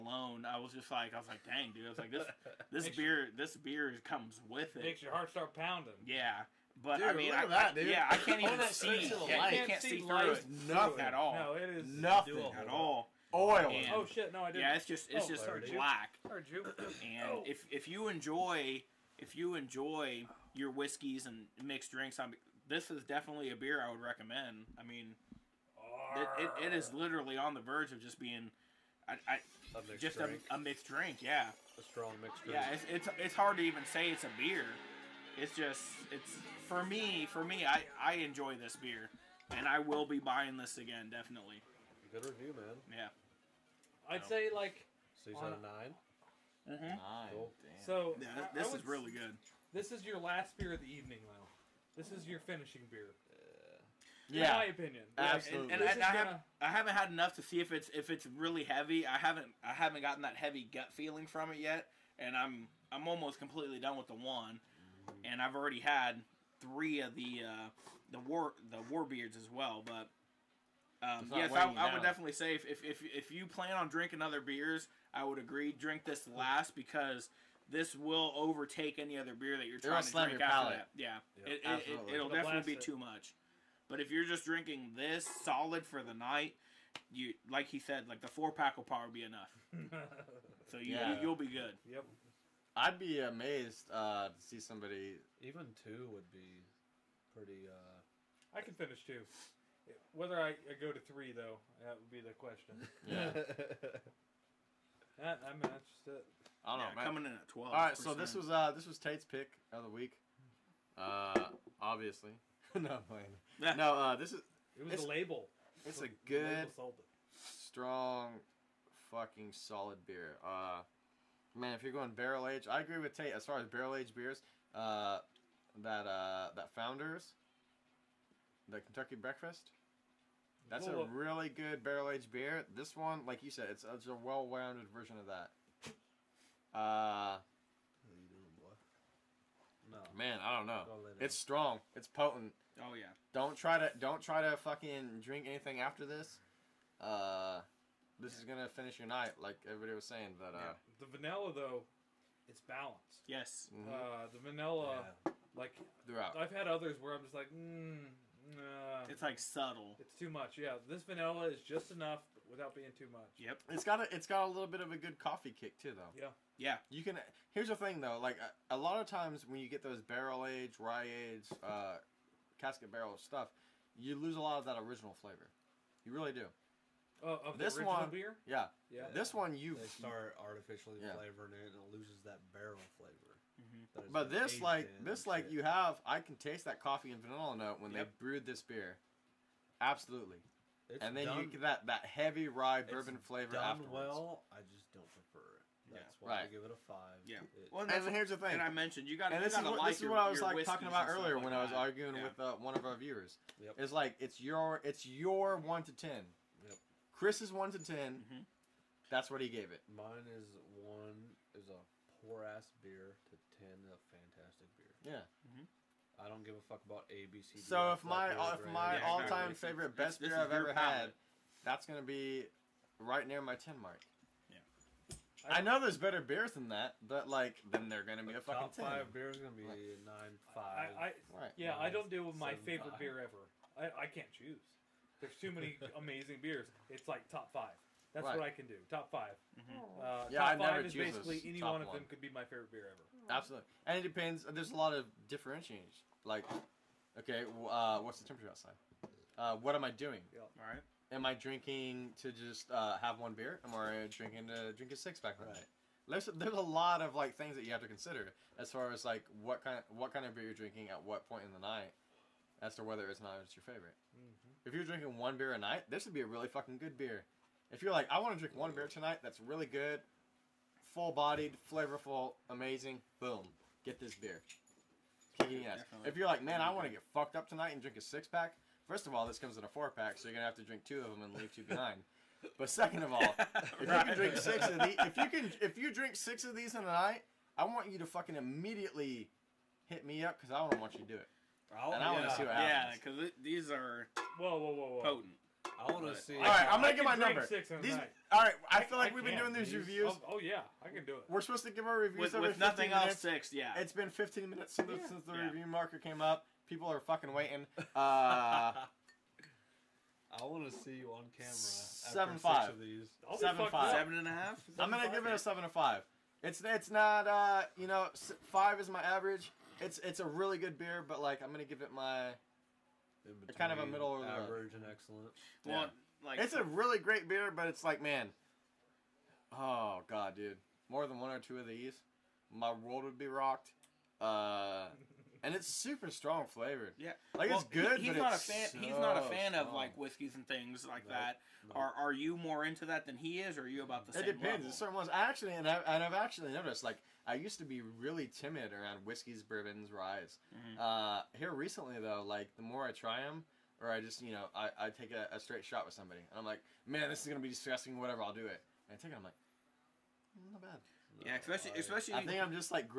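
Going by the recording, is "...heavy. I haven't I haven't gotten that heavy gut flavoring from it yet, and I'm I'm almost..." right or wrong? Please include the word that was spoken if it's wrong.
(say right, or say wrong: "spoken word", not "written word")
wrong: "feeling", not "flavoring".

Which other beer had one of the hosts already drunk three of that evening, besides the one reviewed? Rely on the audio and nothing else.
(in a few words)
Warbeards.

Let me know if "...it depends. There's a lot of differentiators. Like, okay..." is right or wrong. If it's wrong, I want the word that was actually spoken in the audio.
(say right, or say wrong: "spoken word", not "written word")
right.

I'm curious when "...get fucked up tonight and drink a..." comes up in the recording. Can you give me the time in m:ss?
4:36.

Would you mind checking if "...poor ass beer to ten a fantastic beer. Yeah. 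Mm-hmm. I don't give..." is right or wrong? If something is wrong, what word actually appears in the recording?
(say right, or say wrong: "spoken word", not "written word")
right.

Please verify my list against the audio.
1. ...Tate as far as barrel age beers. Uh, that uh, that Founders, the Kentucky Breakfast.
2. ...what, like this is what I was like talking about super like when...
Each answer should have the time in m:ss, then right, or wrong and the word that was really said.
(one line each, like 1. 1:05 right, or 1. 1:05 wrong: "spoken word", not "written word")
1. 2:03 right
2. 3:19 wrong: "earlier", not "super".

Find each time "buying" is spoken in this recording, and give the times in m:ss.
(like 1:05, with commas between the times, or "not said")
0:40.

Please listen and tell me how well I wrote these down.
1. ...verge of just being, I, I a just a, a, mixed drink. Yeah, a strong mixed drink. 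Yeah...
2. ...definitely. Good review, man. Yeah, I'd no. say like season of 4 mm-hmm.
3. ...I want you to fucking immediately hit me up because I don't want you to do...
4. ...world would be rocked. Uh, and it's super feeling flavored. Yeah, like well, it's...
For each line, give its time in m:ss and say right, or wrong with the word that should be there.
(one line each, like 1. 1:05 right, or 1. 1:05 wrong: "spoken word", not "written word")
1. 0:27 right
2. 0:41 wrong: "9", not "4"
3. 4:47 right
4. 5:32 wrong: "strong", not "feeling".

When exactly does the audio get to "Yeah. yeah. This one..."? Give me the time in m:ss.
2:58.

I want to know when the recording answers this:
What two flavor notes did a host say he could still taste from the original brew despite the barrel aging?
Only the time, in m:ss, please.
3:06.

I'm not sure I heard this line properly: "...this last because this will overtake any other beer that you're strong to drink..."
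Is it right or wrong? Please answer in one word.
wrong.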